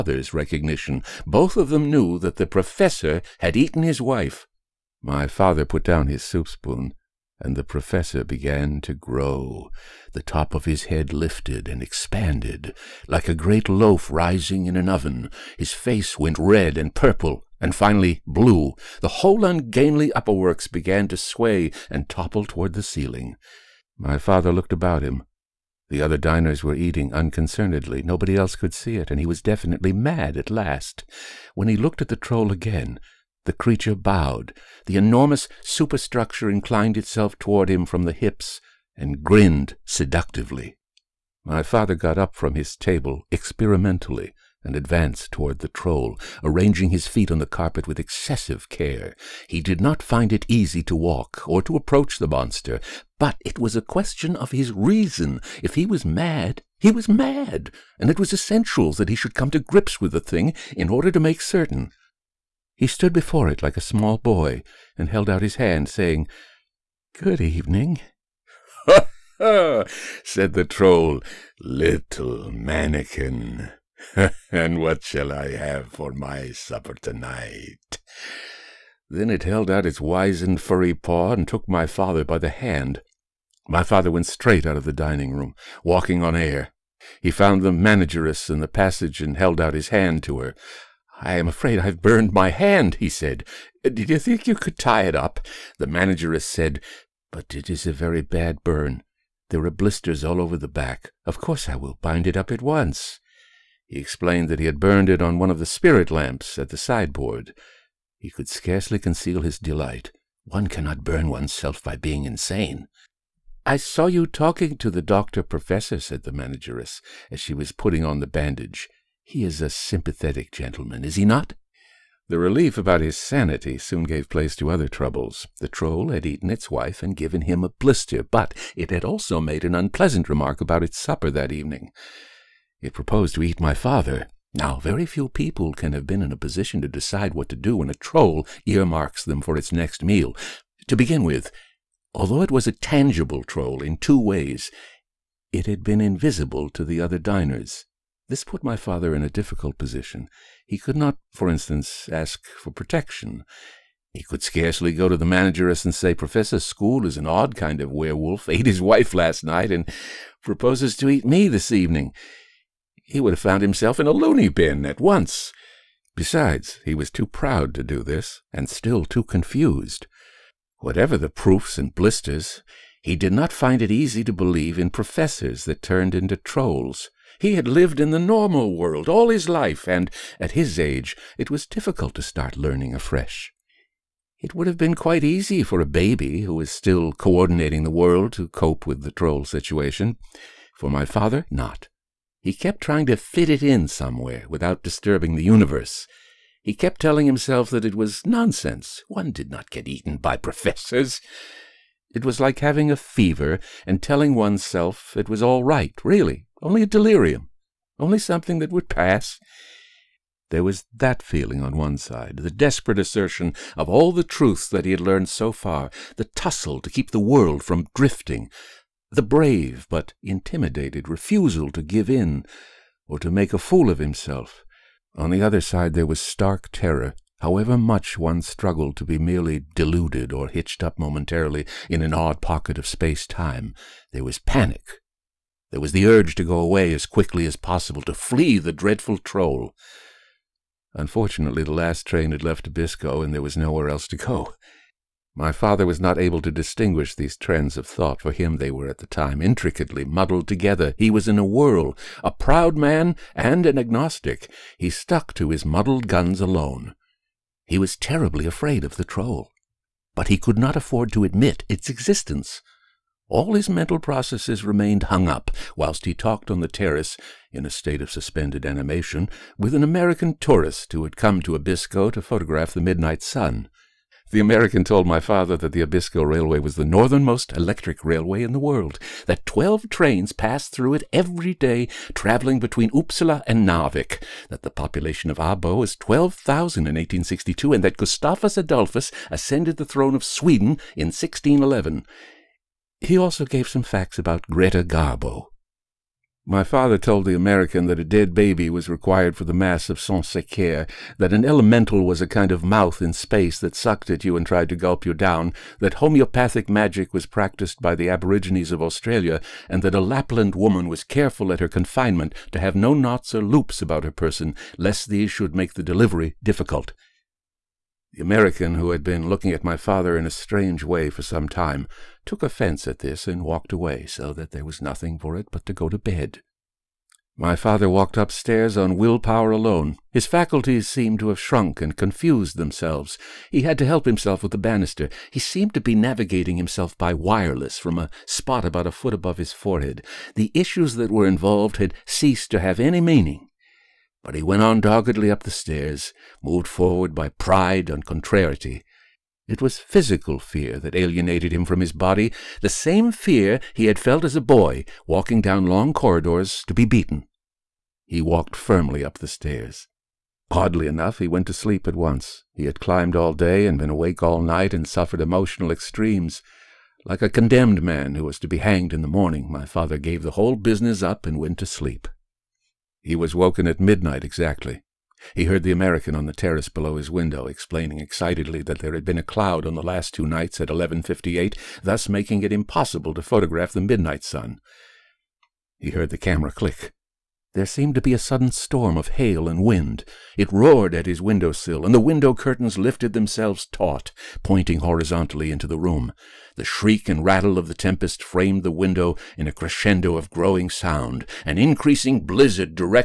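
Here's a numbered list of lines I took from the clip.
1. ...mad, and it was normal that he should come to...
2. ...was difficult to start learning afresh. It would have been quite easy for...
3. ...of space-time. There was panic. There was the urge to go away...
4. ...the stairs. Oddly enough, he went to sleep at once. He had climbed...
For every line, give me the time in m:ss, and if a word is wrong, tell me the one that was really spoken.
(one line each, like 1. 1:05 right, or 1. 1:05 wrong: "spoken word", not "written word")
1. 0:57 wrong: "essential", not "normal"
2. 3:01 right
3. 3:52 right
4. 5:59 right.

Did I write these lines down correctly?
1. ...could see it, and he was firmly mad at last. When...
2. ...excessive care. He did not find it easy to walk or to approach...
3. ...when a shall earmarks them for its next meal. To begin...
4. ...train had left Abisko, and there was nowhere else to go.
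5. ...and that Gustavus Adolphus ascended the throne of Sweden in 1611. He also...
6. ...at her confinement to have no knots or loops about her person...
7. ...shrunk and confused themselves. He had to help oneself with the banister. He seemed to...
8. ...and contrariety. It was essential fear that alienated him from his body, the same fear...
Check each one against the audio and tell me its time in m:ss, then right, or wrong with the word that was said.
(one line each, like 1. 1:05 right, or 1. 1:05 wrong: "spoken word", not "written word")
1. 0:28 wrong: "definitely", not "firmly"
2. 0:47 right
3. 2:17 wrong: "troll", not "shall"
4. 4:02 right
5. 4:47 right
6. 5:11 right
7. 5:31 wrong: "himself", not "oneself"
8. 5:47 wrong: "physical", not "essential".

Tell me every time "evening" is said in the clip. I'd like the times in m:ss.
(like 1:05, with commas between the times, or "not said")
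1:07, 2:11, 2:41.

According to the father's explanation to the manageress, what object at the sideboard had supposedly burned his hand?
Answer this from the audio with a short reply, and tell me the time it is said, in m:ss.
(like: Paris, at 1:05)
spirit lamps, at 1:45.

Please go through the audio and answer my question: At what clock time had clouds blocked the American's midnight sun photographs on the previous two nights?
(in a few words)
11.58.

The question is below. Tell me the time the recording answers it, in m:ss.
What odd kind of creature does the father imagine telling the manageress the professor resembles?
2:37.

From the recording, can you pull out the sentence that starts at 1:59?
He is a sympathetic gentleman, is he not?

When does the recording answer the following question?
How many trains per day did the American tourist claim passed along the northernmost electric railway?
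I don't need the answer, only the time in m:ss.
4:39.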